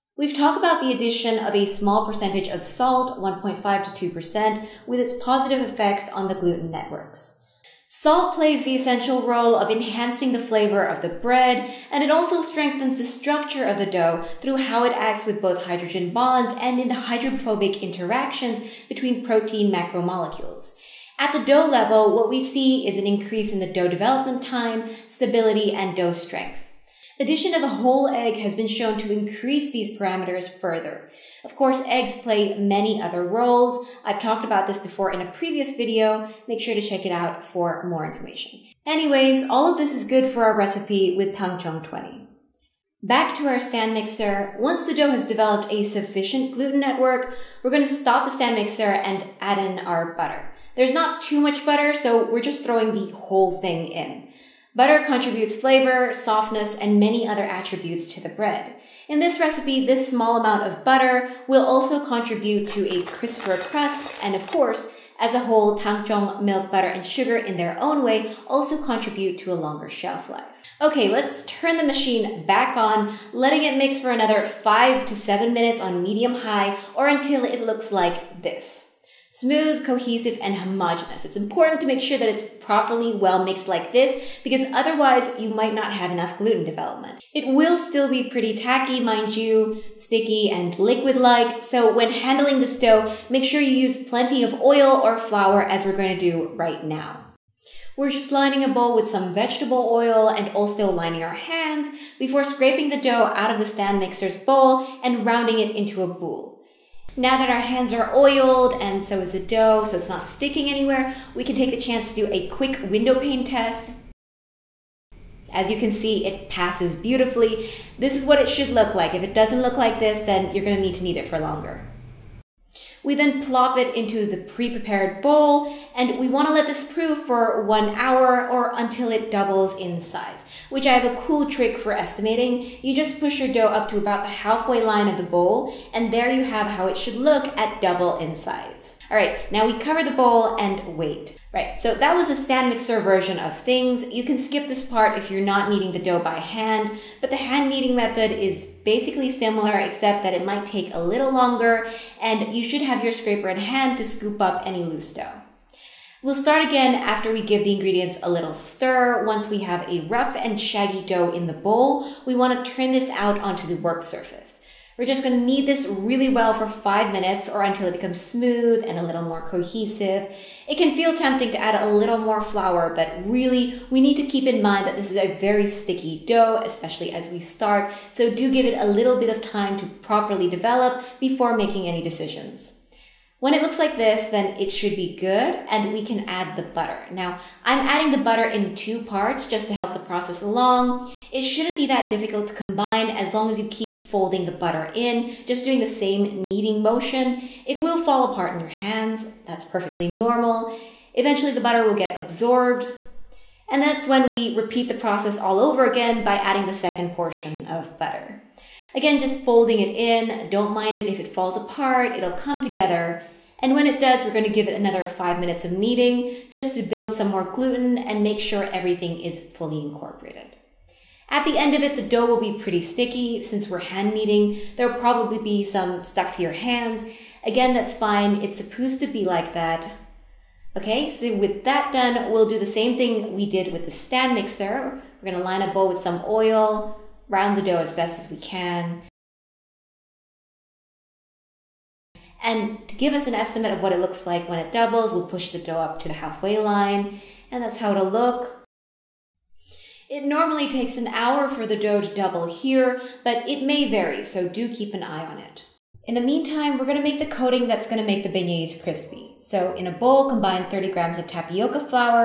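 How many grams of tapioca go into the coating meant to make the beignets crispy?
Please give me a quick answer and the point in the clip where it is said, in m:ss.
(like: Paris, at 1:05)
30, at 4:20.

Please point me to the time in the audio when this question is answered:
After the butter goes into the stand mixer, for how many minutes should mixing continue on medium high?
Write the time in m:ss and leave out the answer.
1:14.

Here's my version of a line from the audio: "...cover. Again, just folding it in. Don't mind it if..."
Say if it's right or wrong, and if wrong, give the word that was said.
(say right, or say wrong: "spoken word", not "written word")
wrong: "butter", not "cover".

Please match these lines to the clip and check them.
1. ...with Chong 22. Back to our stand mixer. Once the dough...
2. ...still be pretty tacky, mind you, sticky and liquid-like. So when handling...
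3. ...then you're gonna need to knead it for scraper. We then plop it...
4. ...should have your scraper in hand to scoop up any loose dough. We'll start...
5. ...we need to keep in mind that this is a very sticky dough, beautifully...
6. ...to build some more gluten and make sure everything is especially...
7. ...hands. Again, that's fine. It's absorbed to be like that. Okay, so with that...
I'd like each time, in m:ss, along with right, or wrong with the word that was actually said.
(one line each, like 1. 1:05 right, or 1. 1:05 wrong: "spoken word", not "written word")
1. 0:41 wrong: "20", not "22"
2. 1:27 right
3. 2:00 wrong: "longer", not "scraper"
4. 2:32 right
5. 2:53 wrong: "especially", not "beautifully"
6. 3:36 wrong: "fully", not "especially"
7. 3:46 wrong: "supposed", not "absorbed".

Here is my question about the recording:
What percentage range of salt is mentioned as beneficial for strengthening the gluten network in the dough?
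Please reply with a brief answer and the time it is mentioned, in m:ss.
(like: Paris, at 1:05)
1.5 to 2%, at 0:03.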